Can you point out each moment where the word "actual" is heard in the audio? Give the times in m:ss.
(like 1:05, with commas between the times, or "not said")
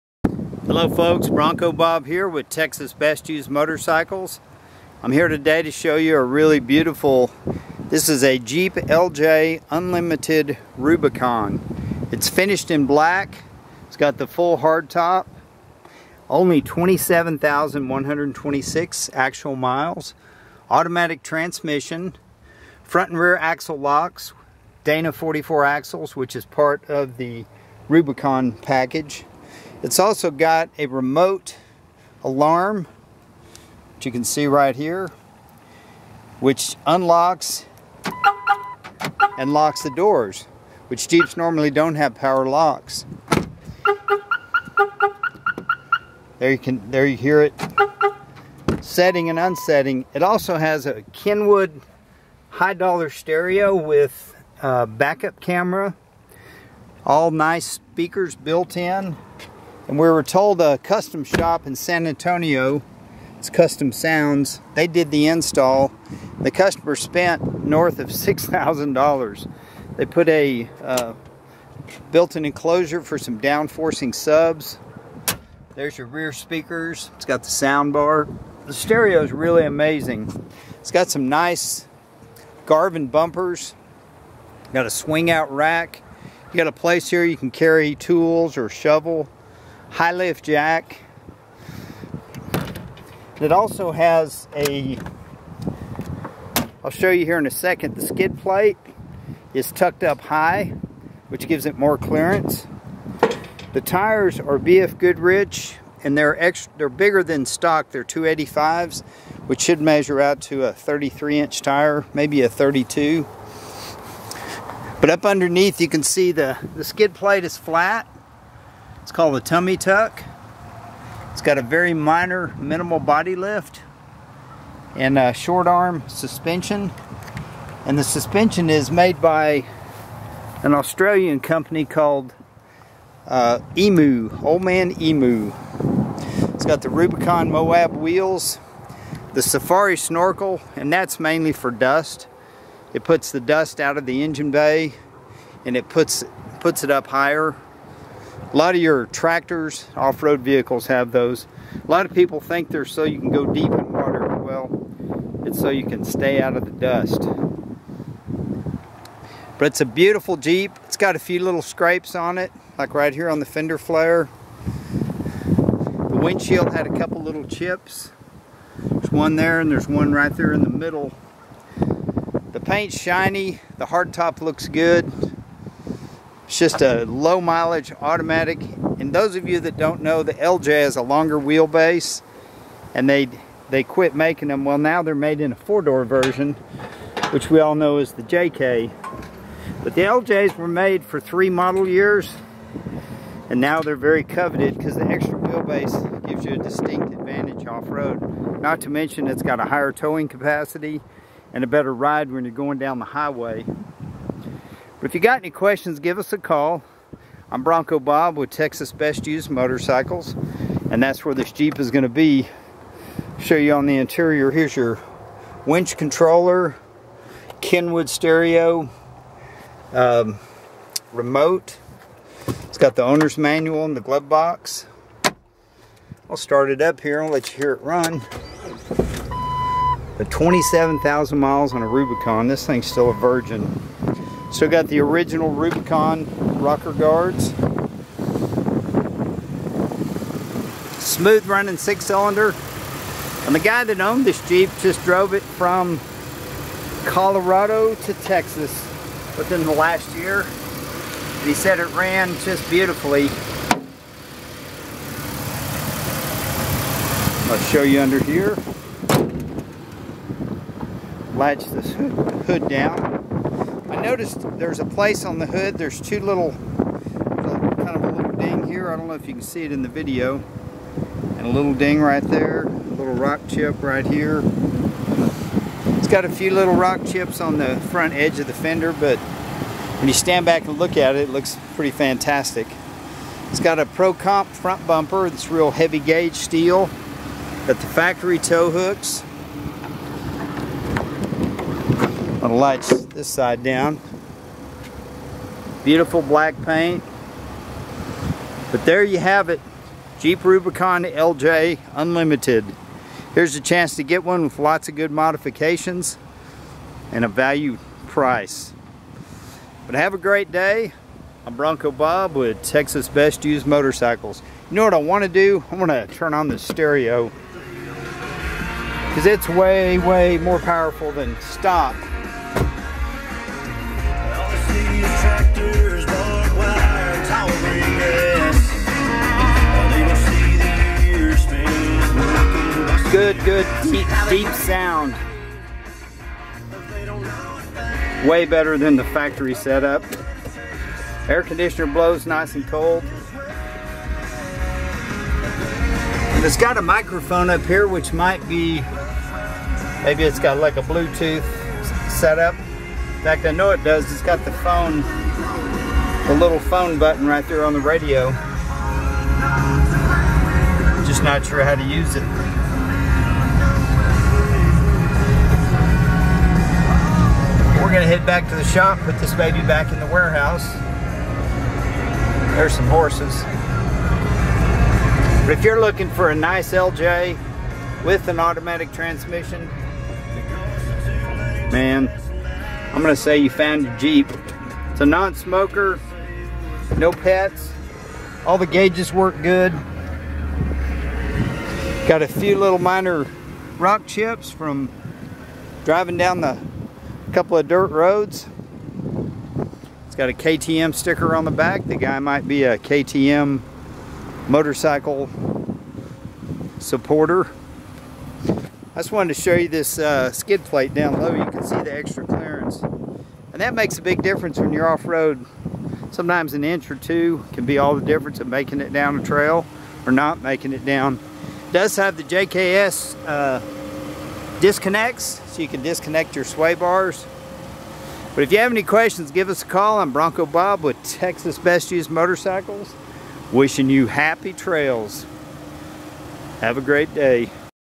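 0:19.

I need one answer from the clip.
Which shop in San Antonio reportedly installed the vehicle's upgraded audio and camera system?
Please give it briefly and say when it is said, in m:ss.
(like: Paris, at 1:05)
Custom Sounds, at 1:03.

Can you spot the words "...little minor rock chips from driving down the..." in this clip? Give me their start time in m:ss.
6:32.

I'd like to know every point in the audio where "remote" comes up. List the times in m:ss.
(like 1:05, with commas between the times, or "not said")
0:30, 3:41.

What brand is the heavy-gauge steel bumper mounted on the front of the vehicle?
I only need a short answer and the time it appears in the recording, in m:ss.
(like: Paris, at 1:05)
Pro Comp, at 4:43.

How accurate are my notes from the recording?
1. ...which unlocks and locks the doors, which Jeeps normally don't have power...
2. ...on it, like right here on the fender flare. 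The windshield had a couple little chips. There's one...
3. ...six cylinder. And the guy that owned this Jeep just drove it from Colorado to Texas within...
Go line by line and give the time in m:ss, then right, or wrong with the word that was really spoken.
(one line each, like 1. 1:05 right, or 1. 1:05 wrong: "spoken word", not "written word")
1. 0:36 right
2. 2:42 right
3. 4:01 right.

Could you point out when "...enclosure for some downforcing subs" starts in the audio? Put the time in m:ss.
1:12.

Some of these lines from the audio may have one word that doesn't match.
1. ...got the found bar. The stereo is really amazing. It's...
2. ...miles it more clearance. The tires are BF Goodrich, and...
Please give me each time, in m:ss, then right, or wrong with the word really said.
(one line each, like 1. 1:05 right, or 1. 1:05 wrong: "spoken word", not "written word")
1. 1:17 wrong: "sound", not "found"
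2. 1:41 wrong: "gives", not "miles".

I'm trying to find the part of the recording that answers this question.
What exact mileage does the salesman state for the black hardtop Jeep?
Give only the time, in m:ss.
0:16.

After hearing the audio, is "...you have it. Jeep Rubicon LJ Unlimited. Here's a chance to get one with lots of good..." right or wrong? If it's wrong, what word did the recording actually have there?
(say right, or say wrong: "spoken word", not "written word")
right.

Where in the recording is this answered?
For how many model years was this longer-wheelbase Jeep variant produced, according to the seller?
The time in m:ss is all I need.
3:11.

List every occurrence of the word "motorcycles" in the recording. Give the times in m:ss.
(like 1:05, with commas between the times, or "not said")
0:03, 3:29, 5:13, 6:44, 7:12.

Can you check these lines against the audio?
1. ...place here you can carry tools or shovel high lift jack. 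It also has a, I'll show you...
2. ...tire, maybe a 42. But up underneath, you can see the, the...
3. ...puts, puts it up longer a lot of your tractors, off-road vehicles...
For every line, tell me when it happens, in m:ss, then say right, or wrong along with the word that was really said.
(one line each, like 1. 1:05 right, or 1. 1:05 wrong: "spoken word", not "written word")
1. 1:26 right
2. 1:51 wrong: "32", not "42"
3. 2:25 wrong: "higher", not "longer".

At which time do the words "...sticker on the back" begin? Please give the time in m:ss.
6:40.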